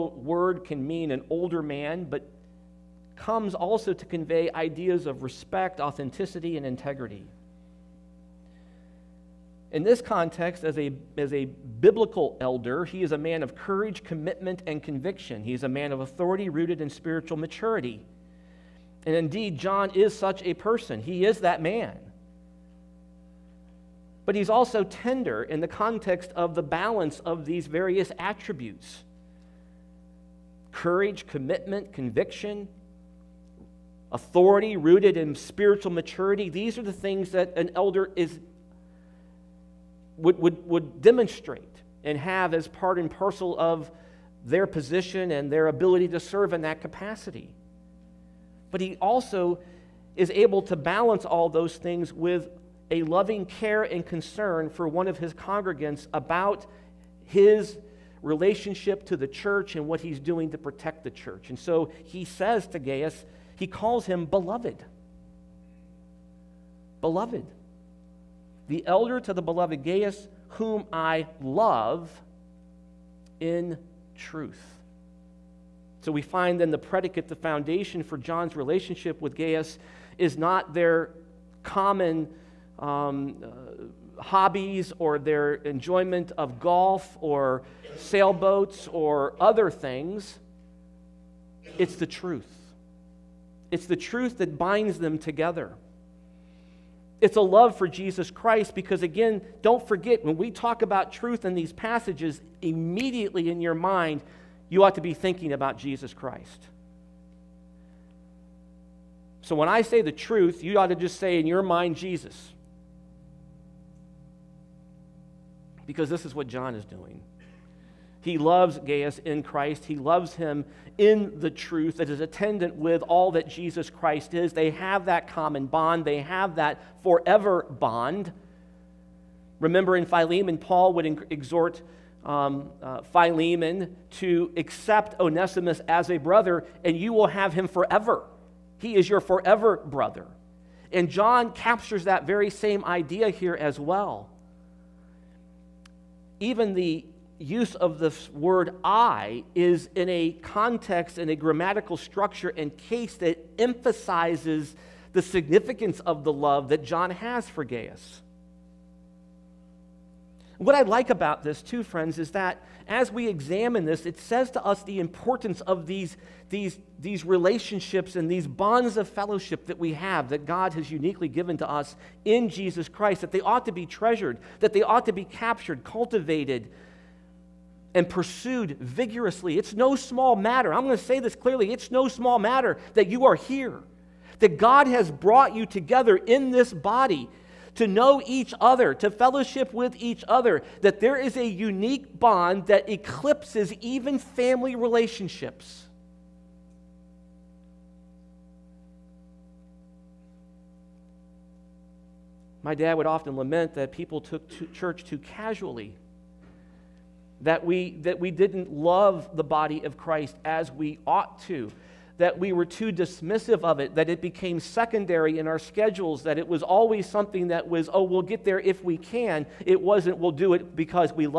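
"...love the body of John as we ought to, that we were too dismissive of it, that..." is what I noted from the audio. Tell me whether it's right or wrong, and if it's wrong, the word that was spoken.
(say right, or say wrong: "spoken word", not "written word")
wrong: "Christ", not "John".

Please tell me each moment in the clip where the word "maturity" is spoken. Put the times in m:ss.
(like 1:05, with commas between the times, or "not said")
0:17, 0:35.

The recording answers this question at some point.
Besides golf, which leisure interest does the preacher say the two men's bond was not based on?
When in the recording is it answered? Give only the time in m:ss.
1:27.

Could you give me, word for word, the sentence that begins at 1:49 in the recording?
So when I say the truth, you ought to just say in your mind, Jesus.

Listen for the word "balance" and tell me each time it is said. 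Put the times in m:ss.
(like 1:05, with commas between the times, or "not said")
0:26, 0:50.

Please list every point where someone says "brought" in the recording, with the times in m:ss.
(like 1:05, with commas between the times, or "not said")
3:05.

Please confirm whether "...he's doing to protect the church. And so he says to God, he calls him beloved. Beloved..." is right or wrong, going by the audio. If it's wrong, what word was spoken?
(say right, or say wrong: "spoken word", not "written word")
wrong: "Gaius", not "God".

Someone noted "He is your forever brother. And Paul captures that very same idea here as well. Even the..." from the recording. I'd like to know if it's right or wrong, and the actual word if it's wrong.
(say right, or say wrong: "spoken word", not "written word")
wrong: "John", not "Paul".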